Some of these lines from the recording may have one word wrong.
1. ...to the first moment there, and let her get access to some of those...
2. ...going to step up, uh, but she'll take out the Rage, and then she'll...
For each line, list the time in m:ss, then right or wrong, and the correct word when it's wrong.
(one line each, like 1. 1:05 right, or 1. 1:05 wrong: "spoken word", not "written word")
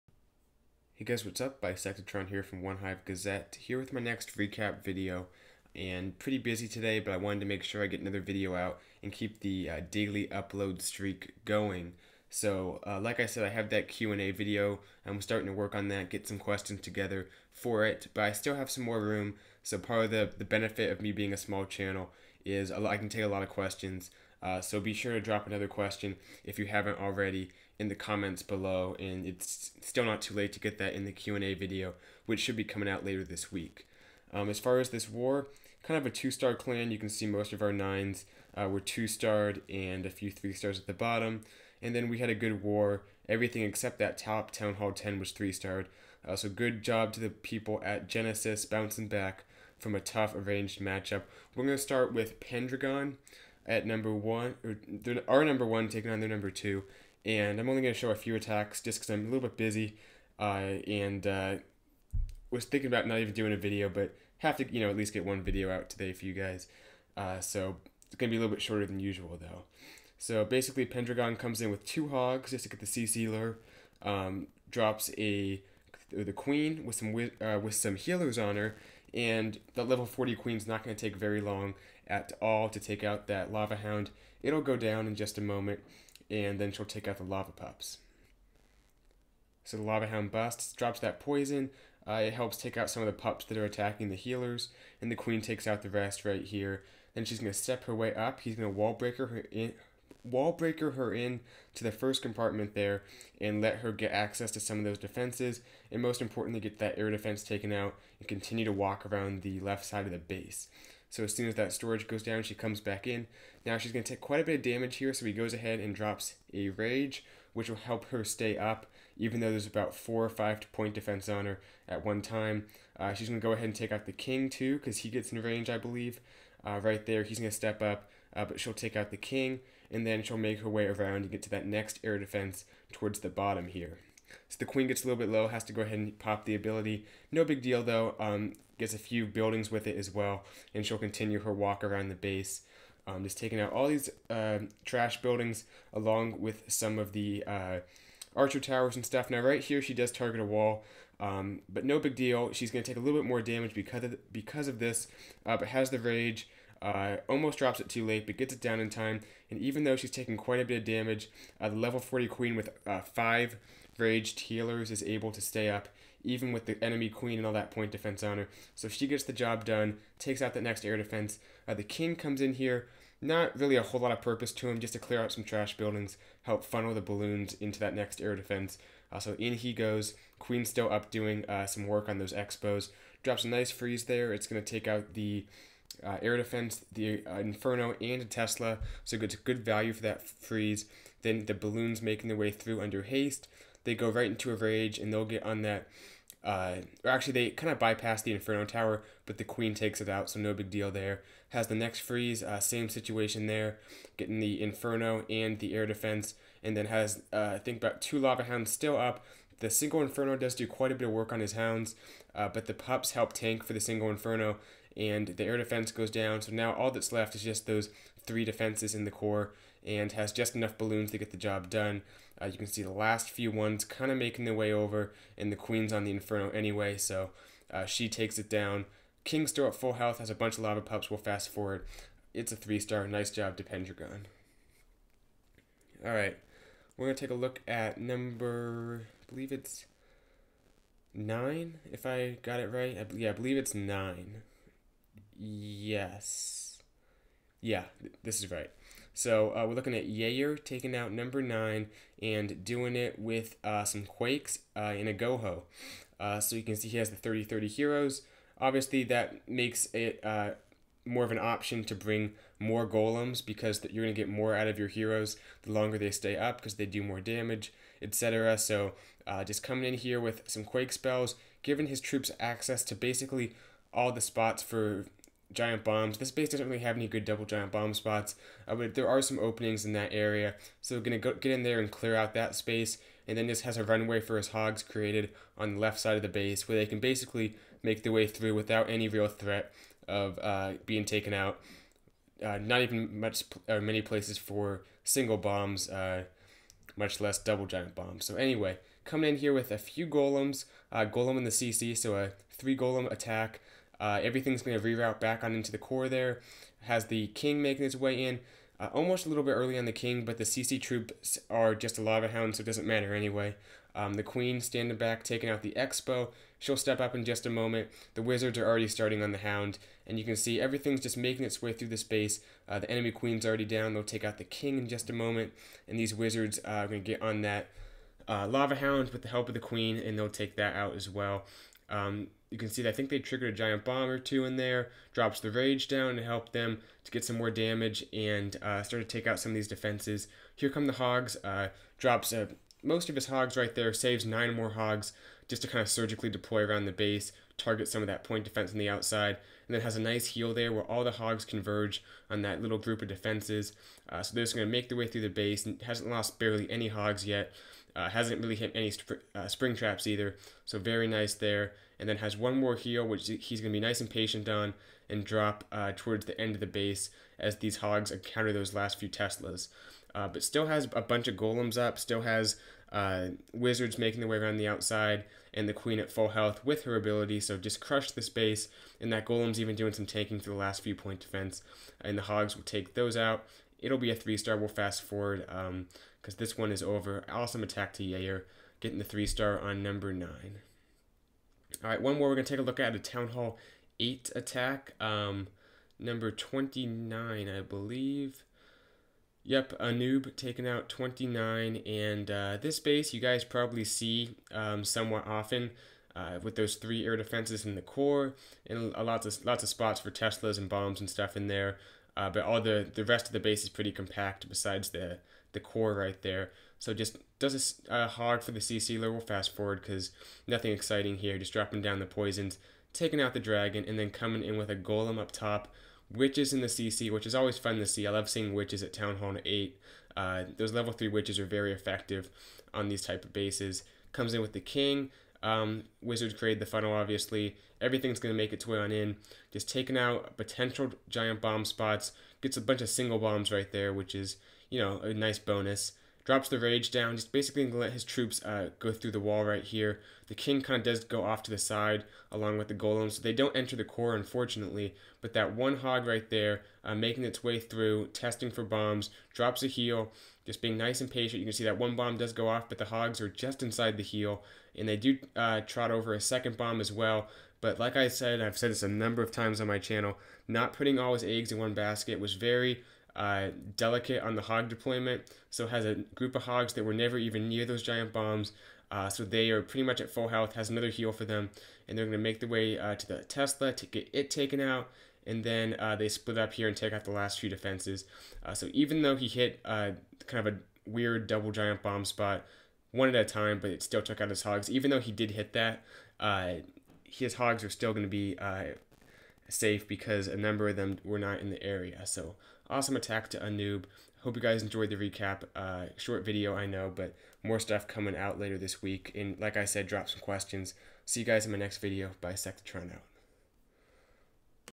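1. 1:41 wrong: "compartment", not "moment"
2. 2:07 wrong: "King", not "Rage".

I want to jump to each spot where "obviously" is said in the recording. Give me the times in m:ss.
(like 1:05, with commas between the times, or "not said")
4:18, 7:16.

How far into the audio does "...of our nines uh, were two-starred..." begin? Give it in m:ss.
0:37.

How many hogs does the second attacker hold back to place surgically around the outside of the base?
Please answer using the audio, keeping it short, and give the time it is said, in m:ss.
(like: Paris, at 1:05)
9, at 5:44.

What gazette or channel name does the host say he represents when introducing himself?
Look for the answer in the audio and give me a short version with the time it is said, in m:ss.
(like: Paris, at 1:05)
One Hive Gazette, at 0:02.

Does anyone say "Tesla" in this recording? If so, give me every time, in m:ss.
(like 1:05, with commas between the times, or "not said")
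3:08, 6:09, 6:50, 8:03.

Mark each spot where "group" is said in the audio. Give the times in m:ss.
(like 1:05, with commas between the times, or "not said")
5:52, 7:56.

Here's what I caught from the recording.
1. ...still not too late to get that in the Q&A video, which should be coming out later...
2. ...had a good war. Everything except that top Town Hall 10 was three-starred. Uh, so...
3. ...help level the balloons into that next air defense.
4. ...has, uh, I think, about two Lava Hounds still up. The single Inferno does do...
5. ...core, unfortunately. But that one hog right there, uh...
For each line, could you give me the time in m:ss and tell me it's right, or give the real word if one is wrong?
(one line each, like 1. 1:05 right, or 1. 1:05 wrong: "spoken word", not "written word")
1. 0:29 right
2. 0:42 right
3. 2:56 wrong: "funnel", not "level"
4. 3:26 right
5. 7:33 right.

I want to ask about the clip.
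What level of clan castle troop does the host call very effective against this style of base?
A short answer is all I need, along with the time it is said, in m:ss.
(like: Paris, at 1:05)
3, at 7:10.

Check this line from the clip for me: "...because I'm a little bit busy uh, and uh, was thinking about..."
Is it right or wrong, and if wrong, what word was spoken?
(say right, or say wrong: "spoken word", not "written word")
right.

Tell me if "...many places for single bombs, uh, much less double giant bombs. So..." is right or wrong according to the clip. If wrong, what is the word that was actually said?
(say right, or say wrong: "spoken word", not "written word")
right.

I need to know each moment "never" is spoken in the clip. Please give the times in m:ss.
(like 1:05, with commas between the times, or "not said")
7:56.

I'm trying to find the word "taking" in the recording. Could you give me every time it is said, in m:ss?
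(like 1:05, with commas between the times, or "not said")
0:55, 2:23, 2:40, 4:10, 5:15, 6:40, 7:02, 7:19.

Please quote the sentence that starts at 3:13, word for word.
They go right into a rage and they'll get on that.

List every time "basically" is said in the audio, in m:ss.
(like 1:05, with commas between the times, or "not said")
1:10, 4:32, 4:46, 7:27.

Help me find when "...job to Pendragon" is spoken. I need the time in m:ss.
3:53.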